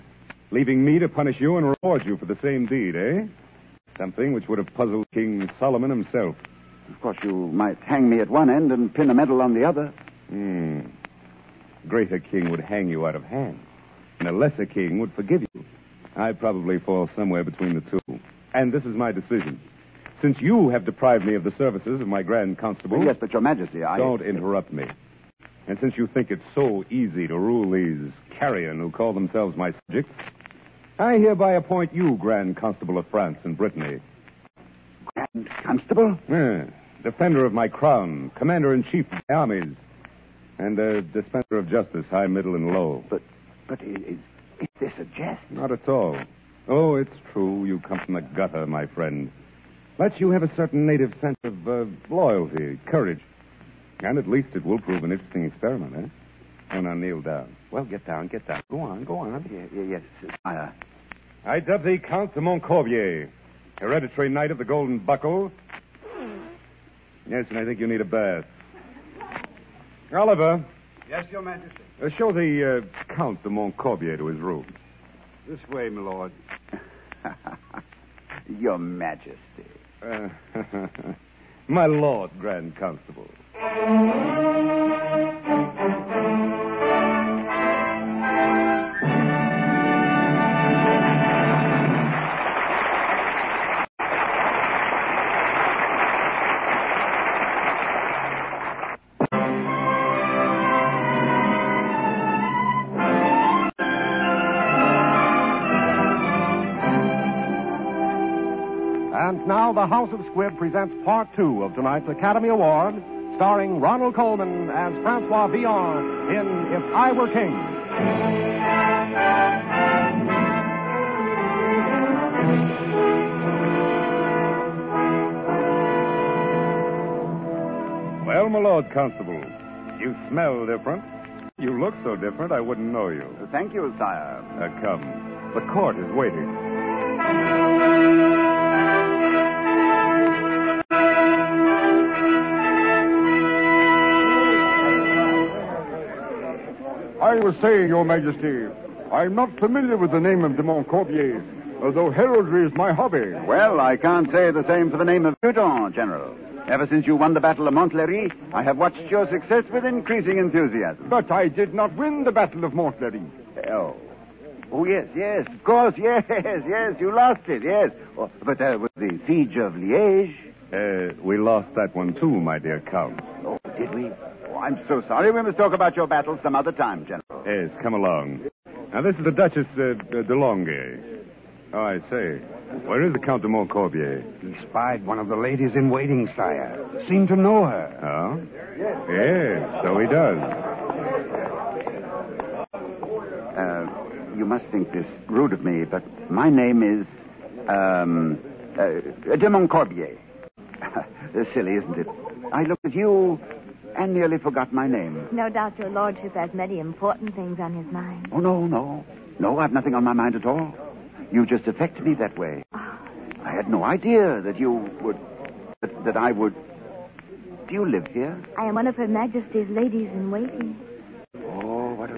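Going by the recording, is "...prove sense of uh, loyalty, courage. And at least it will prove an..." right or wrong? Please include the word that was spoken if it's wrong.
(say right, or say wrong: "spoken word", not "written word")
wrong: "native", not "prove".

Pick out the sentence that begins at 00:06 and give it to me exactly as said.
Of course, you might hang me at one end and pin a medal on the other.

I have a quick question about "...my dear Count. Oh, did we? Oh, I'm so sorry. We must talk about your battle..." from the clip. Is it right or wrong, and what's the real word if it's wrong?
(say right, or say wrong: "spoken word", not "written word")
right.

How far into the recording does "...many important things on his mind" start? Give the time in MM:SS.
03:26.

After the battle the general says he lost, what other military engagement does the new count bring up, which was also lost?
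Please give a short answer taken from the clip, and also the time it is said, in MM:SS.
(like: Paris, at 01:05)
Siege of Liege, at 02:49.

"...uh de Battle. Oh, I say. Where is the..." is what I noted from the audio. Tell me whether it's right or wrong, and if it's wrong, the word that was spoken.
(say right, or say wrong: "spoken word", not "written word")
wrong: "Longue", not "Battle".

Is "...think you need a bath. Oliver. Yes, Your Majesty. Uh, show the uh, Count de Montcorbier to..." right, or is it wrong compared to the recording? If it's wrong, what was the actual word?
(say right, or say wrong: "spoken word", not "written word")
right.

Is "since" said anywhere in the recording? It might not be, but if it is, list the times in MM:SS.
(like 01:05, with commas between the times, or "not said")
00:20, 00:25, 02:36.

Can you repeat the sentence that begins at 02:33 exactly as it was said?
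Well, I can't say the same for the name of Newton, General.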